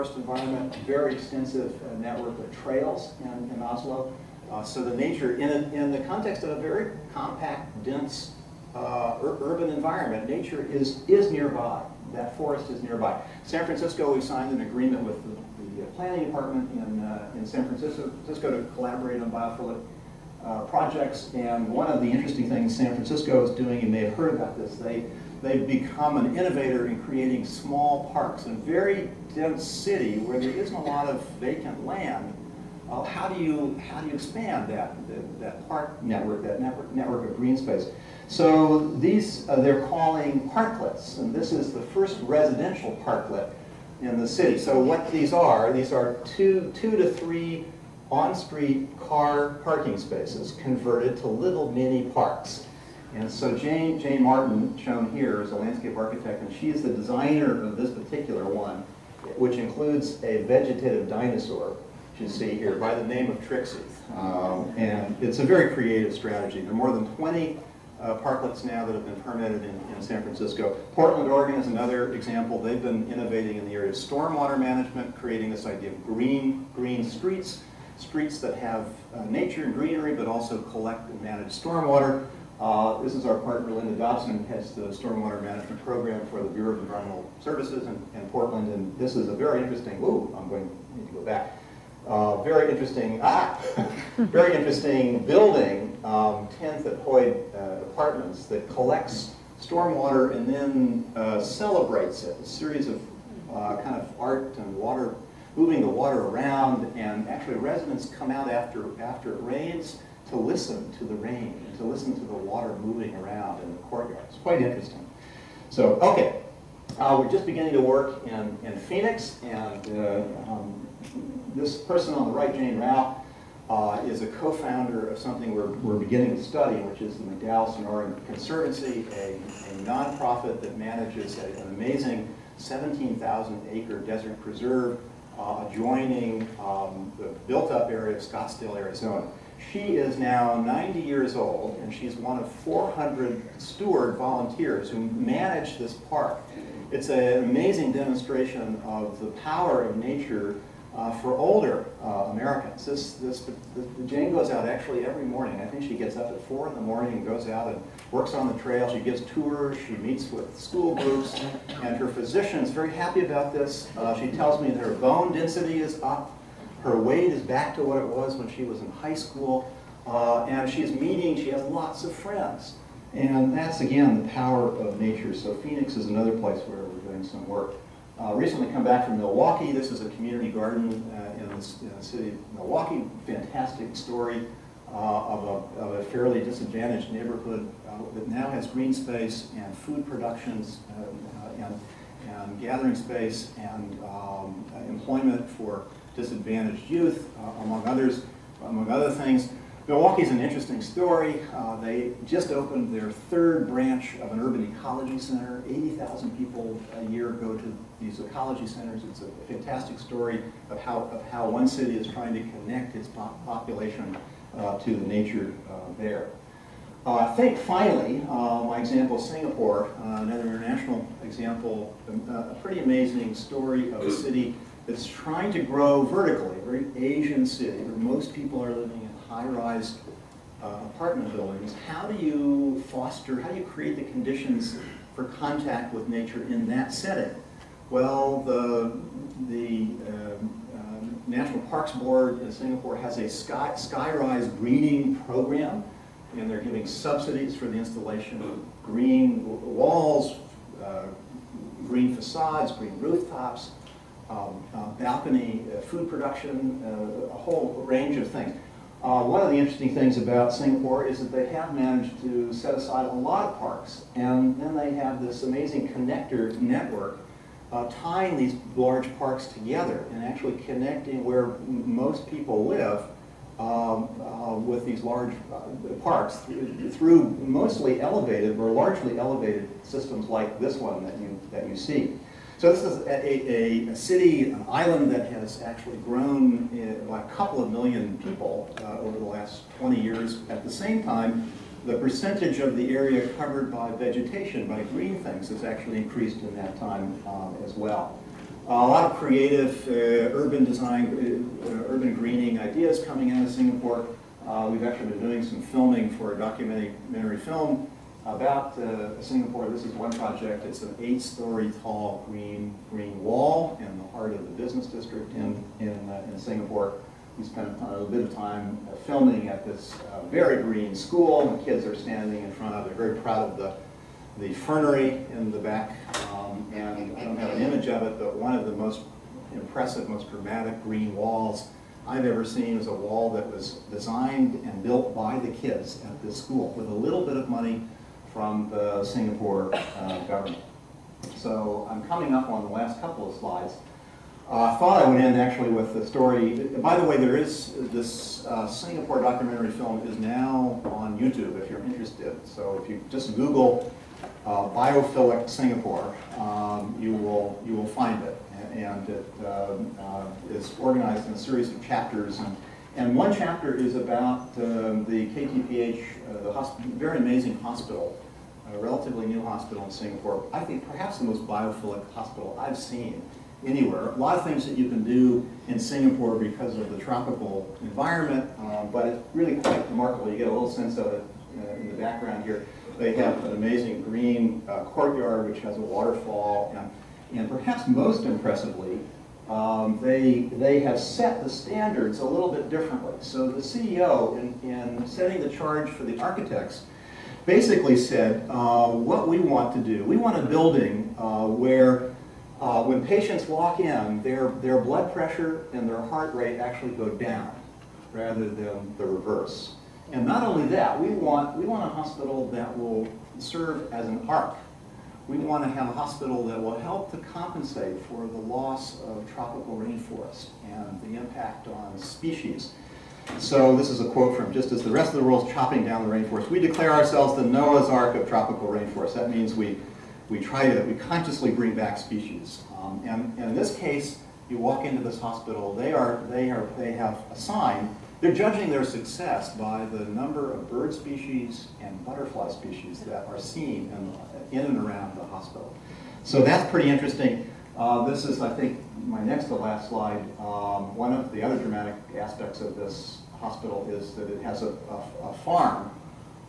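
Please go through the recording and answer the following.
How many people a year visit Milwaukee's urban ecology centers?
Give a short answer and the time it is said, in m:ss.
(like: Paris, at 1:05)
80,000, at 3:25.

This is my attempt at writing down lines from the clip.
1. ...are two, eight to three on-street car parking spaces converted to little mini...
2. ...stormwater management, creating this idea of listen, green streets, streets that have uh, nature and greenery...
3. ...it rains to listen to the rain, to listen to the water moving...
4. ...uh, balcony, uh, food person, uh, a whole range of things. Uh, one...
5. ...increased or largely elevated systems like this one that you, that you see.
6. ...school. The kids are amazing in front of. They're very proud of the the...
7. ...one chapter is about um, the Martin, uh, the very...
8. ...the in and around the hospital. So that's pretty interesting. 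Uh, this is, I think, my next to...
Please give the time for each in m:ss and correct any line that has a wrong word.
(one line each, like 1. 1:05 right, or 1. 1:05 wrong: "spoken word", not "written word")
1. 0:45 wrong: "two", not "eight"
2. 1:13 wrong: "green", not "listen"
3. 1:49 right
4. 4:14 wrong: "production", not "person"
5. 4:38 wrong: "elevated", not "increased"
6. 5:20 wrong: "standing", not "amazing"
7. 6:03 wrong: "KTPH", not "Martin"
8. 7:24 right.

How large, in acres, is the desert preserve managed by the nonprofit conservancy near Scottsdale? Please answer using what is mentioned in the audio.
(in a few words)
17,000 acres.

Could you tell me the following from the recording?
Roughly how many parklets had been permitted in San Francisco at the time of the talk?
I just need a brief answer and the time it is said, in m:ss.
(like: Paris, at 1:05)
more than 20, at 1:06.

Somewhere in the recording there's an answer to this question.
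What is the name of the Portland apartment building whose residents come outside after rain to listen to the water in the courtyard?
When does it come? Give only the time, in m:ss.
1:36.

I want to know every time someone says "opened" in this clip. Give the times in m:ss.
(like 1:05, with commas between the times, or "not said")
3:22.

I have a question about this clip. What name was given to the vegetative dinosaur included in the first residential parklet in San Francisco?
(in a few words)
Trixie.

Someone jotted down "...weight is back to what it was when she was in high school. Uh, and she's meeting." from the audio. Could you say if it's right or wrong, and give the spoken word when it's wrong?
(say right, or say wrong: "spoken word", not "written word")
right.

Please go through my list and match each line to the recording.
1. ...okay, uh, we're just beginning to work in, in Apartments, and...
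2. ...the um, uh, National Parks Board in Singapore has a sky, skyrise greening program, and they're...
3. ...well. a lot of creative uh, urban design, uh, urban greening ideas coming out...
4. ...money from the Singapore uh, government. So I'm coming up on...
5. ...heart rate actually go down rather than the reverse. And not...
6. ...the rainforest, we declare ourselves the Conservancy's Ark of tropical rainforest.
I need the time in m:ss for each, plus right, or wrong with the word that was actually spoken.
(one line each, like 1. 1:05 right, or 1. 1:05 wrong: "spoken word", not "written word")
1. 1:56 wrong: "Phoenix", not "Apartments"
2. 3:59 right
3. 4:57 right
4. 5:37 right
5. 6:46 right
6. 7:06 wrong: "Noah", not "Conservancy".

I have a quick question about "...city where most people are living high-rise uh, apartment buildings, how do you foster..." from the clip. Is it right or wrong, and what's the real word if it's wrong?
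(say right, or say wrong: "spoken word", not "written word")
right.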